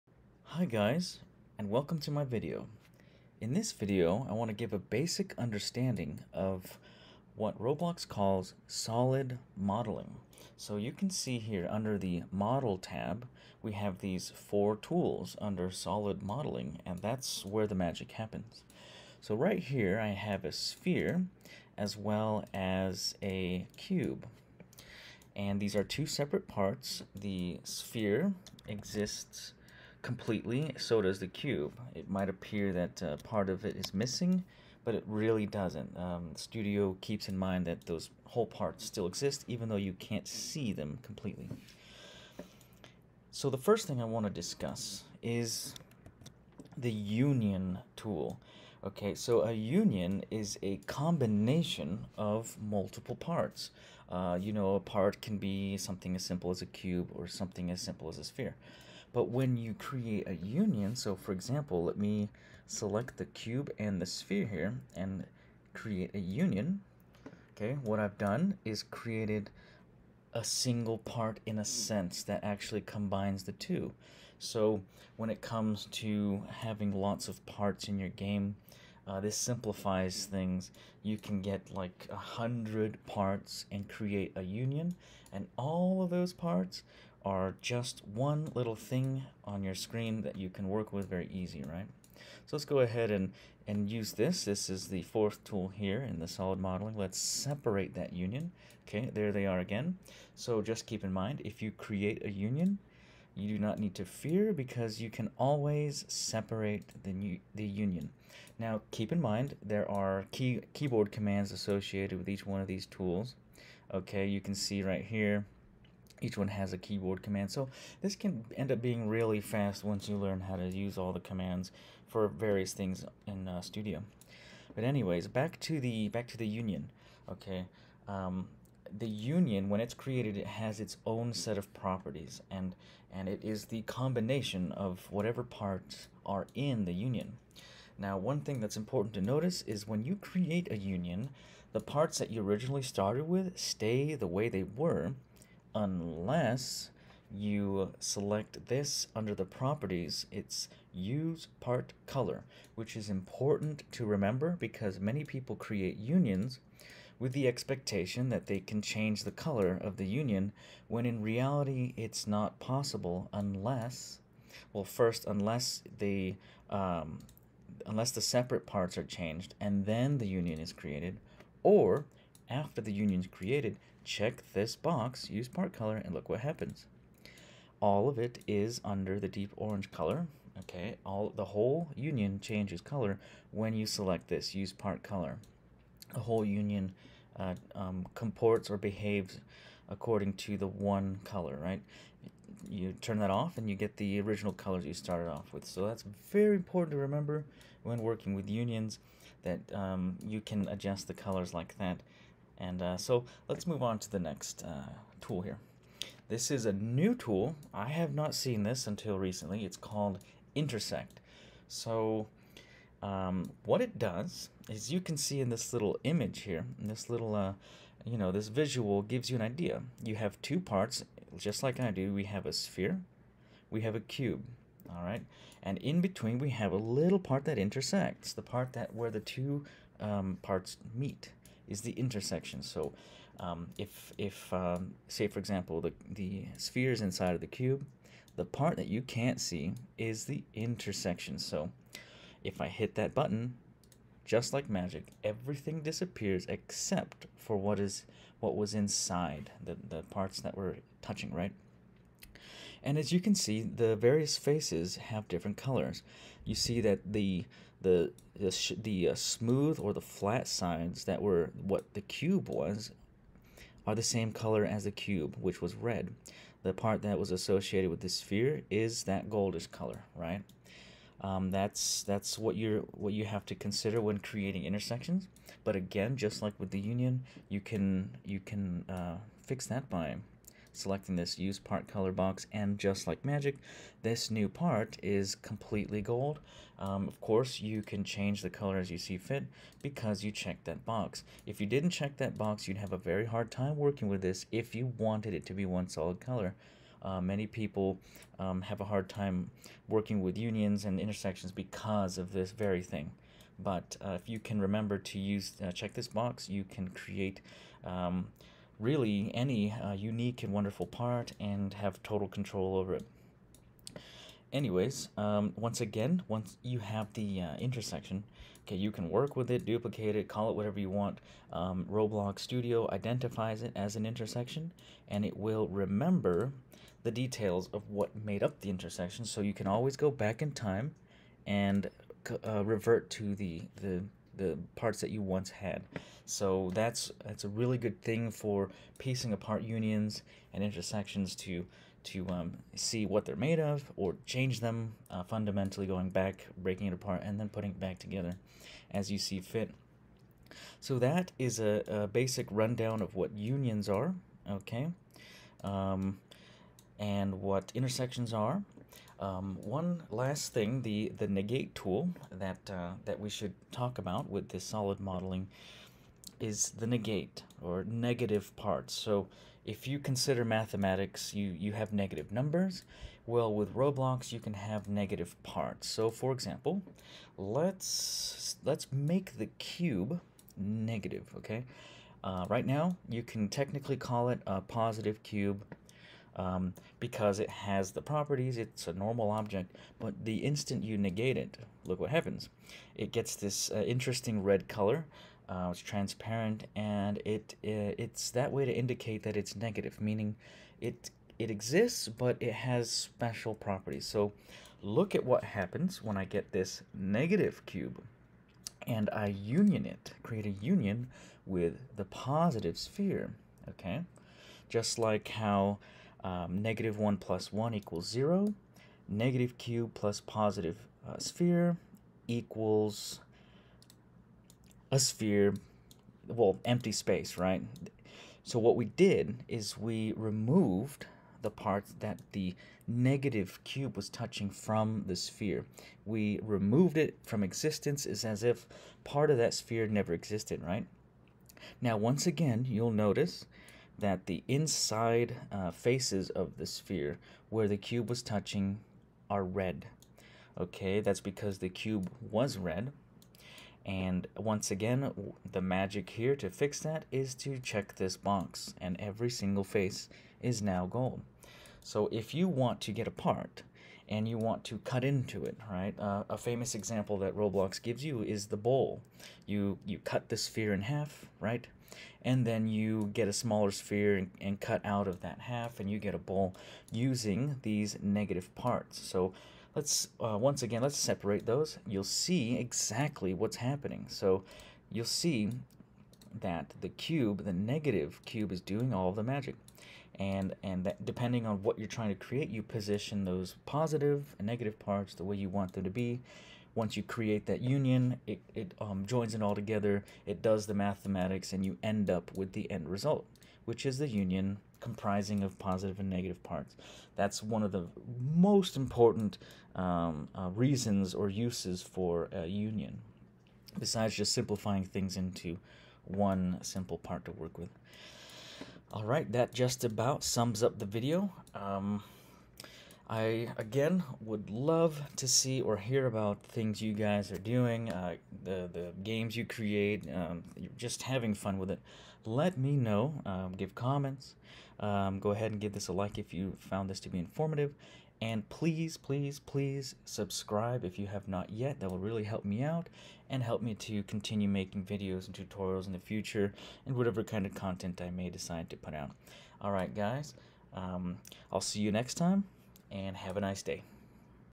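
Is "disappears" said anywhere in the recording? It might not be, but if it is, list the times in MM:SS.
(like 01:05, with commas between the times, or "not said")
04:05.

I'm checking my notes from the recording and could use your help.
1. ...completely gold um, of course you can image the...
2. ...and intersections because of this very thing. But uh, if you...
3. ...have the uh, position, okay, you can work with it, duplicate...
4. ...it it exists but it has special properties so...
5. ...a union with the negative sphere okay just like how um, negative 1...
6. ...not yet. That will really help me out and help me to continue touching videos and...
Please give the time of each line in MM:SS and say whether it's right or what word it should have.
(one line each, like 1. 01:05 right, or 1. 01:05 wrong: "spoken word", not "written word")
1. 04:45 wrong: "change", not "image"
2. 05:00 right
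3. 05:16 wrong: "intersection", not "position"
4. 06:40 right
5. 06:50 wrong: "positive", not "negative"
6. 09:01 wrong: "making", not "touching".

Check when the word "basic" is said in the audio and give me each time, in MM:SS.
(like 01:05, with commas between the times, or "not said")
00:04, 05:52.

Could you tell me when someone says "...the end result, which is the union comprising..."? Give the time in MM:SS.
08:22.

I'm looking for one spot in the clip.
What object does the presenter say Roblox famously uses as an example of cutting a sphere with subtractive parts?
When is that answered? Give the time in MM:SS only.
07:48.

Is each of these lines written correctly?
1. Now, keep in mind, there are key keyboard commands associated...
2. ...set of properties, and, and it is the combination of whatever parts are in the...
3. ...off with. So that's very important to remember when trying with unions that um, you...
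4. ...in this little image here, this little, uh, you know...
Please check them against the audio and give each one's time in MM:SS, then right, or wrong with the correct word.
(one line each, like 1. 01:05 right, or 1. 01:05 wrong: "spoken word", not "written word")
1. 01:48 right
2. 02:11 right
3. 03:15 wrong: "working", not "trying"
4. 03:35 right.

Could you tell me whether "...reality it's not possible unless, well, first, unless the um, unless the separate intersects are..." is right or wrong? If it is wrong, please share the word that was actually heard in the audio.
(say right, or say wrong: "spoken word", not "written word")
wrong: "parts", not "intersects".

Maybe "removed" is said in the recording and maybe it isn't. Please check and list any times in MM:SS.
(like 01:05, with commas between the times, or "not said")
07:10, 07:16.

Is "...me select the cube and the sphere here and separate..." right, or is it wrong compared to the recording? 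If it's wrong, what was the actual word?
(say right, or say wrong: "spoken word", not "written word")
wrong: "create", not "separate".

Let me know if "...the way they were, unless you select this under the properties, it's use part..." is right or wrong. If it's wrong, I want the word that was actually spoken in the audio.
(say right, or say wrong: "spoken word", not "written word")
right.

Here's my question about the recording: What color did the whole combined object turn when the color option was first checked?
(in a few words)
Deep orange.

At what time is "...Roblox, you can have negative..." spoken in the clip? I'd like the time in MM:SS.
06:13.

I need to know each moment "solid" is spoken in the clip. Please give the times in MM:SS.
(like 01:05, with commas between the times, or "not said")
00:08, 00:15, 01:36, 04:55, 06:04.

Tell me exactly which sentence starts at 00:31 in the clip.
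It might appear that uh, part of it is missing, but it really doesn't.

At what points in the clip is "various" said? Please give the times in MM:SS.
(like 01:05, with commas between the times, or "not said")
02:02, 04:13.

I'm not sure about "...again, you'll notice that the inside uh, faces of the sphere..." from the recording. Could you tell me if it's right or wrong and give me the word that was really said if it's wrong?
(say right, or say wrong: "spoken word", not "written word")
right.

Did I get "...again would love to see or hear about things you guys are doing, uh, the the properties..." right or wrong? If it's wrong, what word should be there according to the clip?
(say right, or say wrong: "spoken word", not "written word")
wrong: "games", not "properties".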